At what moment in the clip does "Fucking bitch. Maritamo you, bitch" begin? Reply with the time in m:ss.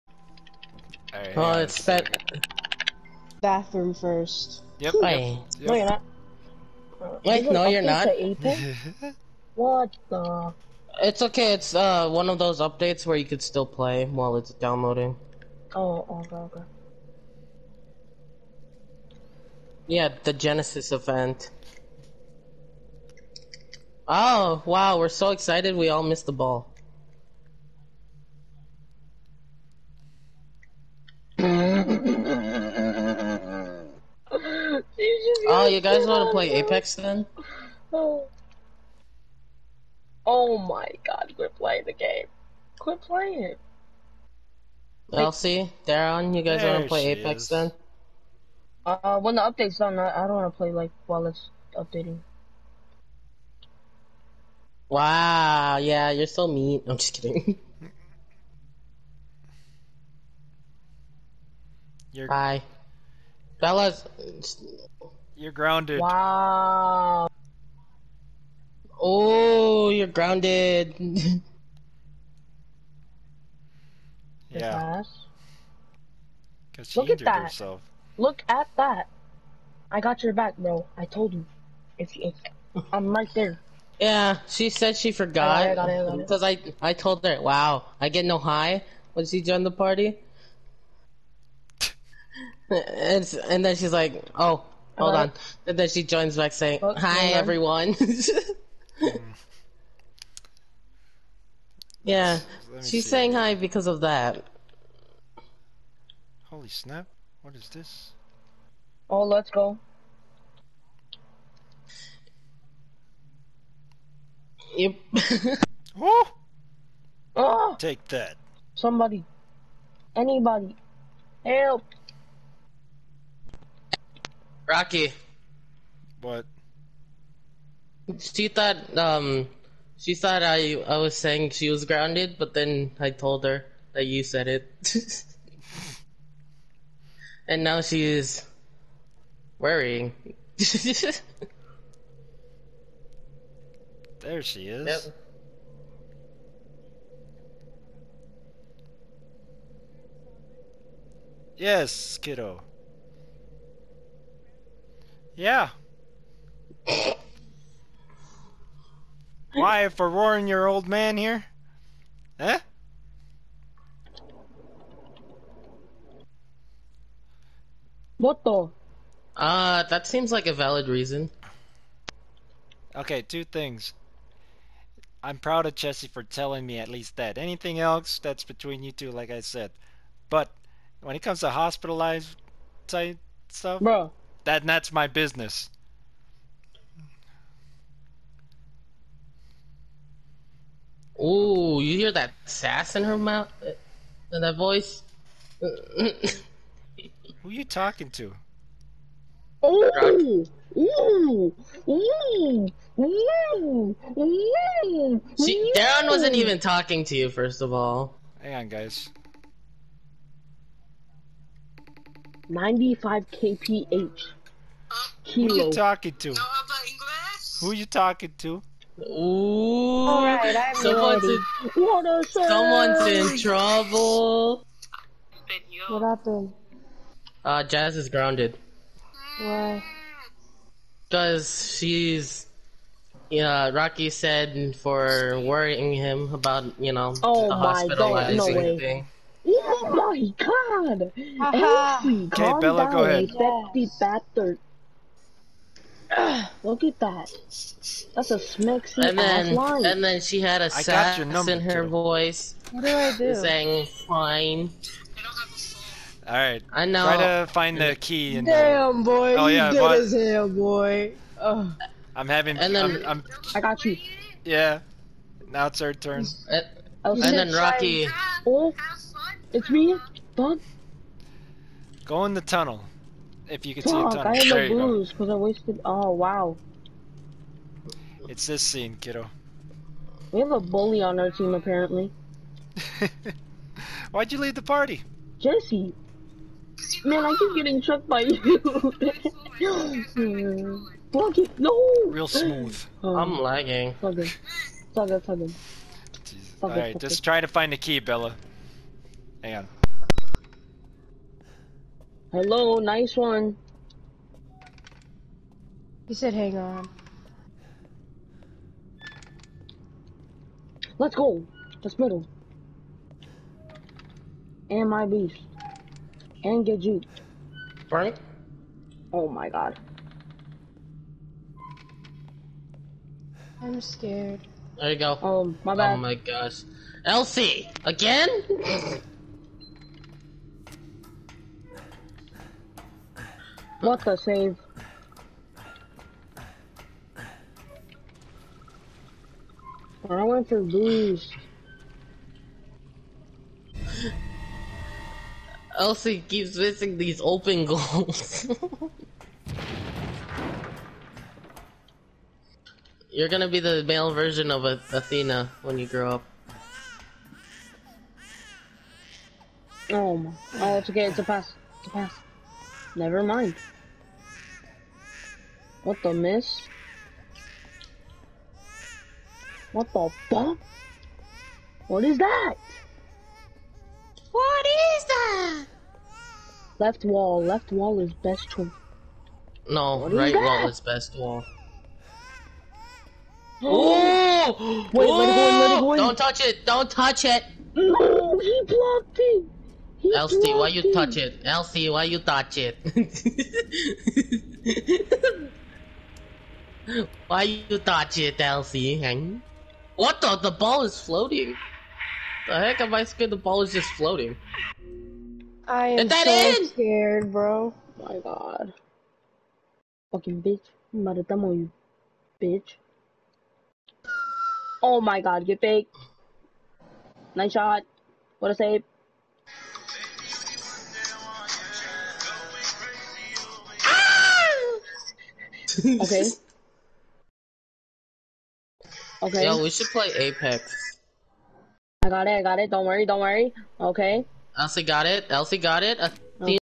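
6:50.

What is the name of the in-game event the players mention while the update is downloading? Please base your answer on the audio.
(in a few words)
Genesis.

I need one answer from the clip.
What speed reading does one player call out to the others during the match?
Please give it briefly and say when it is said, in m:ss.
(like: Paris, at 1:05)
95 kph, at 3:32.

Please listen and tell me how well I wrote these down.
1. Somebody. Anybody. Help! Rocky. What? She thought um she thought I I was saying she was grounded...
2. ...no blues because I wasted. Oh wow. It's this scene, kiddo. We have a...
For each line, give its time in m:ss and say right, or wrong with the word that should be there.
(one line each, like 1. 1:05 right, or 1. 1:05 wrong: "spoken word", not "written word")
1. 1:58 right
2. 4:34 right.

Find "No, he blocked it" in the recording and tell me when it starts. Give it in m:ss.
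6:27.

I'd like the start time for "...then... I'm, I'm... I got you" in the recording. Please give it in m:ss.
4:22.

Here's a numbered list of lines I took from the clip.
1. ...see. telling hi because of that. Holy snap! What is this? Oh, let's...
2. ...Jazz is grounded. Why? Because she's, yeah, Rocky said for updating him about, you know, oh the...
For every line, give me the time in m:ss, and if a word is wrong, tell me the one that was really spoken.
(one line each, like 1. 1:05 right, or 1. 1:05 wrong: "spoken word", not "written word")
1. 1:42 wrong: "saying", not "telling"
2. 3:47 wrong: "worrying", not "updating".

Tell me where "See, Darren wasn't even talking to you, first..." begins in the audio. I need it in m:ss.
3:25.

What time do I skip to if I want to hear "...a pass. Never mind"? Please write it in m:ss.
6:01.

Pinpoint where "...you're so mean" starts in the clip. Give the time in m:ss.
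0:56.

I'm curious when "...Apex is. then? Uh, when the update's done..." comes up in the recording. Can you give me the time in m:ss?
0:47.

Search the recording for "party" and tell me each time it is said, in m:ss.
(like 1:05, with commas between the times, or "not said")
1:29, 4:44.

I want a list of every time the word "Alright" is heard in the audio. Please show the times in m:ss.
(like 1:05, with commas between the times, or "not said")
0:01, 4:16, 4:56.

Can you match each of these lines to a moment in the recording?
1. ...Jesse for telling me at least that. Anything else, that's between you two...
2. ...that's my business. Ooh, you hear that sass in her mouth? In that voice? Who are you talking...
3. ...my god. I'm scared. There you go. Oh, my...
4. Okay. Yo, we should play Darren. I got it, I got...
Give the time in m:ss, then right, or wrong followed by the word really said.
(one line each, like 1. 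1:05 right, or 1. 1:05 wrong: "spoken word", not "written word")
1. 2:55 right
2. 3:04 right
3. 5:19 right
4. 7:09 wrong: "Apex", not "Darren".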